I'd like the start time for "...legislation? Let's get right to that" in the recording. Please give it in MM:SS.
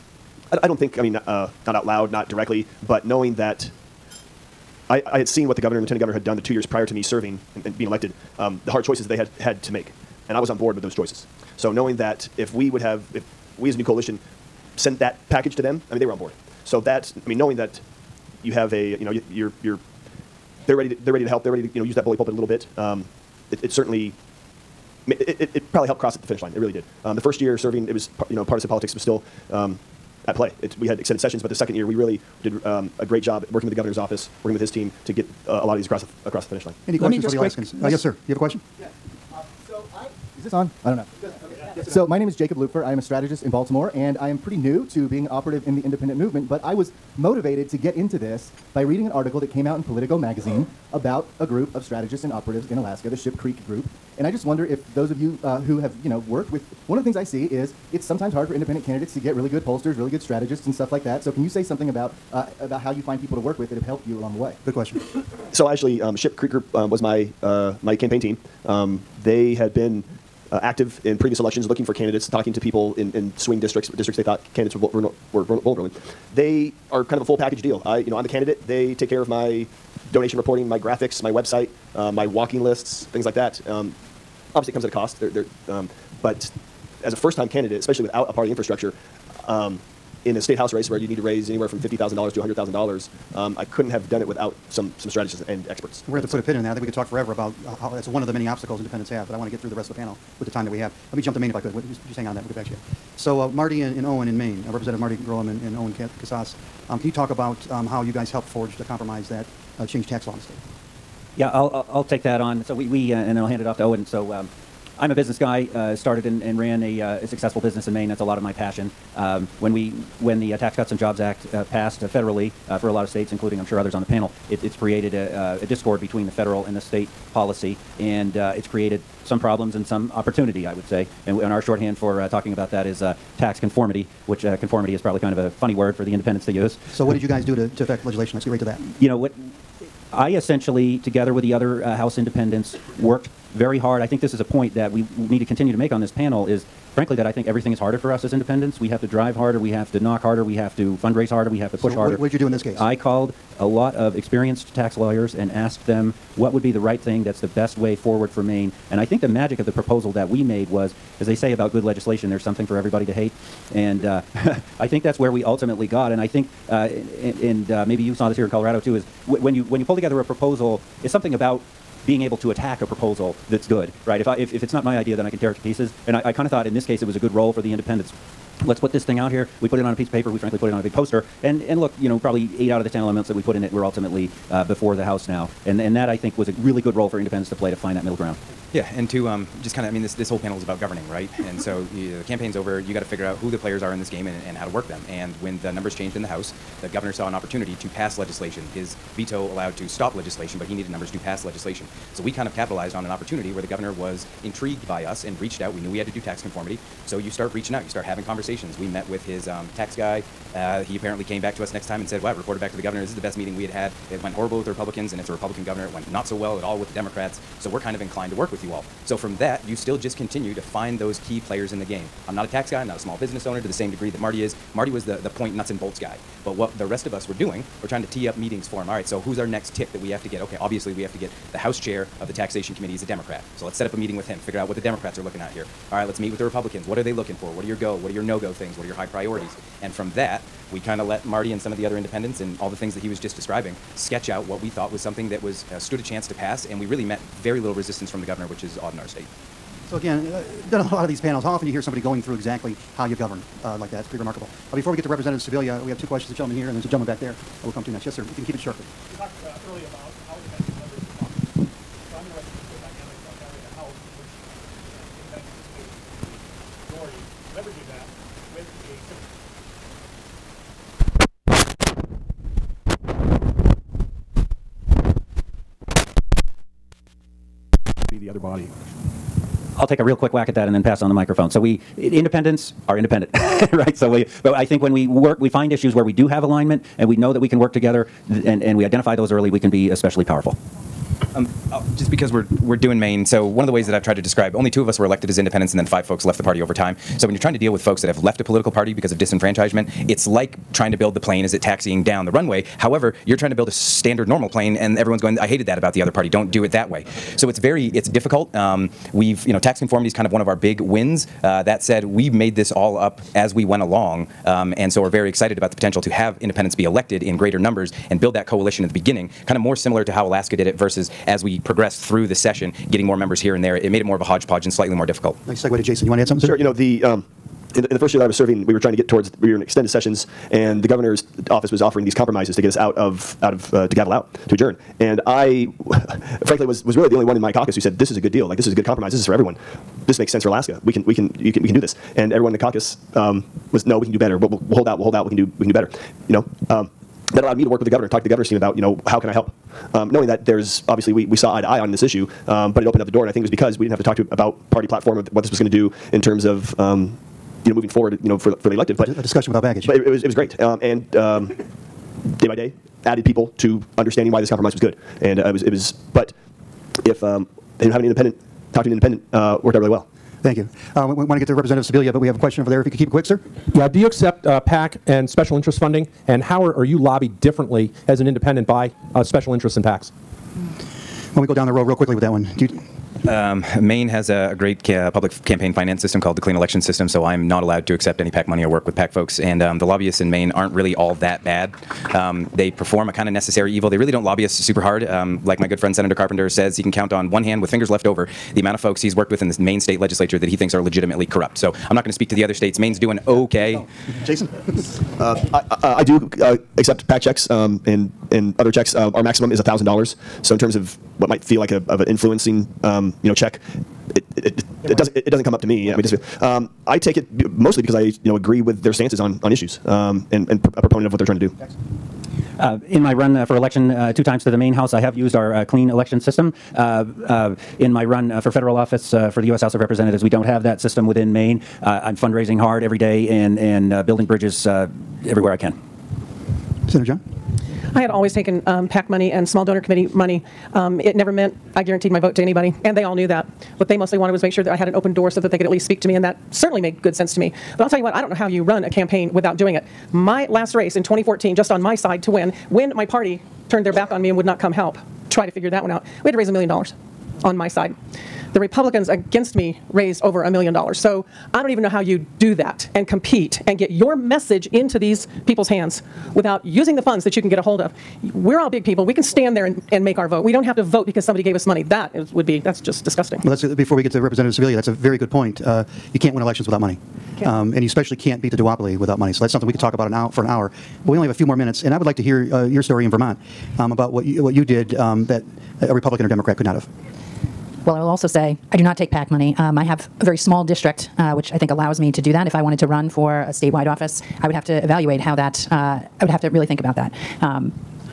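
02:18.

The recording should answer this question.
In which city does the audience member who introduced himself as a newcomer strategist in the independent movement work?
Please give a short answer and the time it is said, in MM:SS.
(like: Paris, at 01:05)
Baltimore, at 00:43.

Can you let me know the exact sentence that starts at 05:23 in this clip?
It made it more of a hodgepodge and slightly more difficult.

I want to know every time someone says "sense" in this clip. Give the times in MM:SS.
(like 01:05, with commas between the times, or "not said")
05:40, 07:27.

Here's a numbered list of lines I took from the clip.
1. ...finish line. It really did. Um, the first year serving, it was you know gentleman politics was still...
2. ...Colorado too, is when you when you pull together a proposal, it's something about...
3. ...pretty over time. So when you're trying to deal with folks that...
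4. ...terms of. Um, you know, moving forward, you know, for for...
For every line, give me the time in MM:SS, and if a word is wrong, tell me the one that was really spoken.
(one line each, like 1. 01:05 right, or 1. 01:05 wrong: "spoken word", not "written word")
1. 00:26 wrong: "partisan", not "gentleman"
2. 02:48 right
3. 04:56 wrong: "party", not "pretty"
4. 05:56 right.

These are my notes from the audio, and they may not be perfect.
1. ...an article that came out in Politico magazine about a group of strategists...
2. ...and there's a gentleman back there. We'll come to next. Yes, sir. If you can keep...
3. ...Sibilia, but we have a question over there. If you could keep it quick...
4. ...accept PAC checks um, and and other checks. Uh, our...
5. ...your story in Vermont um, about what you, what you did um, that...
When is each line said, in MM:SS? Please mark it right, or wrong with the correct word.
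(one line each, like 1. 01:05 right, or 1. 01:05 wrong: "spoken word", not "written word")
1. 00:49 right
2. 04:16 right
3. 06:11 right
4. 06:46 right
5. 08:02 right.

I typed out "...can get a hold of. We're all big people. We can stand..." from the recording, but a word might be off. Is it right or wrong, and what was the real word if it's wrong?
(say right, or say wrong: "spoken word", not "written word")
right.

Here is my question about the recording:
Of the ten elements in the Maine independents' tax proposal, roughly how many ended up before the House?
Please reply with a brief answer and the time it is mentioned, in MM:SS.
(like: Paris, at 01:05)
8, at 03:02.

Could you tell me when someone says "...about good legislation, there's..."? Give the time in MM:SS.
02:41.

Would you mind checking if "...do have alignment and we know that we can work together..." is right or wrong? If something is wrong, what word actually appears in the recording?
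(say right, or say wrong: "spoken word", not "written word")
right.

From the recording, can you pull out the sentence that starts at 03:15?
And when the numbers changed in the House, the governor saw an opportunity to pass legislation.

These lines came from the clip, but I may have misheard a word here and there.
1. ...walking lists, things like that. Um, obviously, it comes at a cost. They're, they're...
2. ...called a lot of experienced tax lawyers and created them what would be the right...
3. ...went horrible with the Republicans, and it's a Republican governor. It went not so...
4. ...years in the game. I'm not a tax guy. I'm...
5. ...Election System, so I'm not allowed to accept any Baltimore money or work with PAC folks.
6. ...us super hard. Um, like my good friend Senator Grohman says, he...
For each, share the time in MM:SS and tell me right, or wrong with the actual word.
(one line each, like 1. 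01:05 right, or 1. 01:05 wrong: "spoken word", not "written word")
1. 01:22 right
2. 02:32 wrong: "asked", not "created"
3. 03:34 right
4. 03:41 wrong: "players", not "years"
5. 06:26 wrong: "PAC", not "Baltimore"
6. 06:34 wrong: "Carpenter", not "Grohman".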